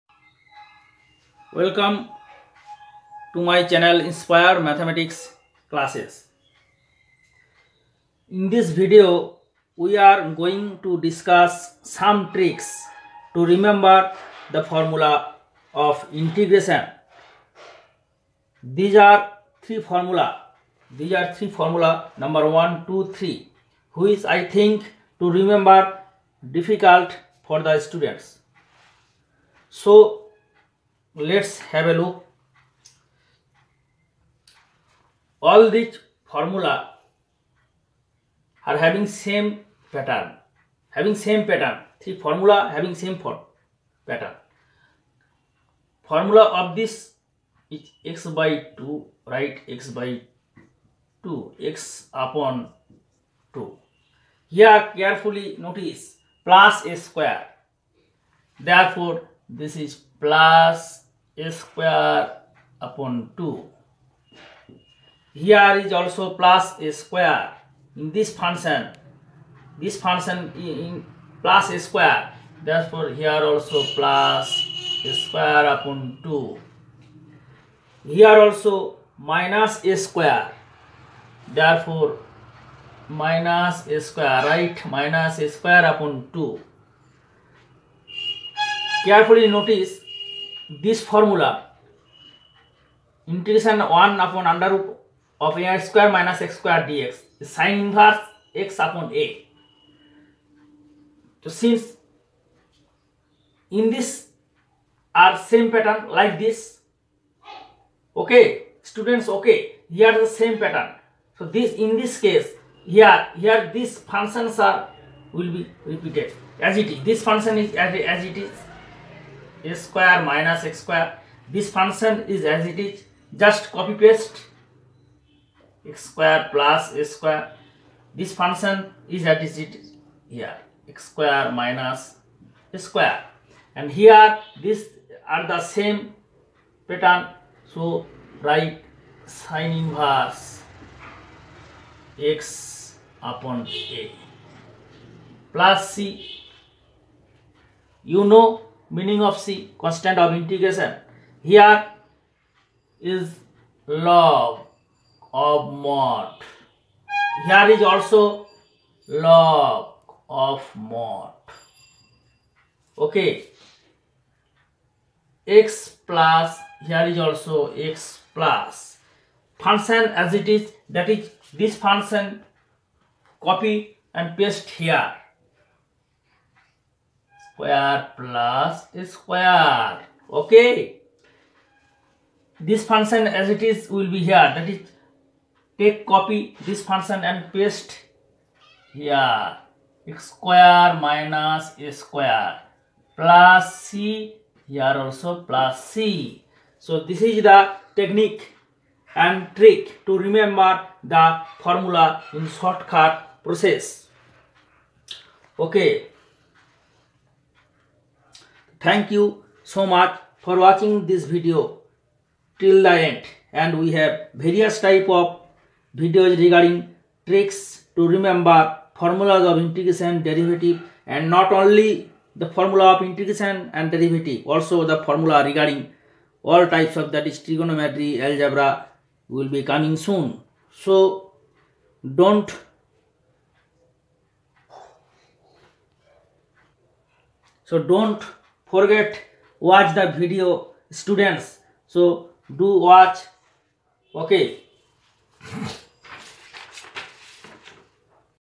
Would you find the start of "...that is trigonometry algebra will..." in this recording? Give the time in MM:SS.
03:47.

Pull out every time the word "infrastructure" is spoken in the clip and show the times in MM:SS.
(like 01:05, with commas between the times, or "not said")
not said.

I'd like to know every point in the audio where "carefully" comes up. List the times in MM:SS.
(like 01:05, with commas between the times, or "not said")
00:54, 01:29.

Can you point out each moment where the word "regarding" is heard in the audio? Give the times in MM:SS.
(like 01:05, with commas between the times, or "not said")
03:36, 03:45.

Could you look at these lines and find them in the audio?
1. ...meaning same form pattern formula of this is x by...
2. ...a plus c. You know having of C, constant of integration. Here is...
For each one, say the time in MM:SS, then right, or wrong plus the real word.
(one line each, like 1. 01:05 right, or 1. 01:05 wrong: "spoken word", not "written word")
1. 00:42 wrong: "having", not "meaning"
2. 02:23 wrong: "meaning", not "having".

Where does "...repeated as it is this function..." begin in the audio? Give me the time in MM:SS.
01:55.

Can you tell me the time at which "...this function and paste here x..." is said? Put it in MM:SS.
03:06.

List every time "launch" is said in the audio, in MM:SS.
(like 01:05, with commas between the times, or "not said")
not said.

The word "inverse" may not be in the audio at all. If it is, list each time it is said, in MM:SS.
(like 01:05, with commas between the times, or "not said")
01:37, 02:19.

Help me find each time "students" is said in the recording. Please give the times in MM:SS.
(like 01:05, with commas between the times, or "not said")
00:27, 01:48, 04:00.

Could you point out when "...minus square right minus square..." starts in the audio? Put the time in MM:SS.
01:23.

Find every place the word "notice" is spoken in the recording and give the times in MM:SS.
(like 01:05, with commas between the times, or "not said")
00:55, 01:29.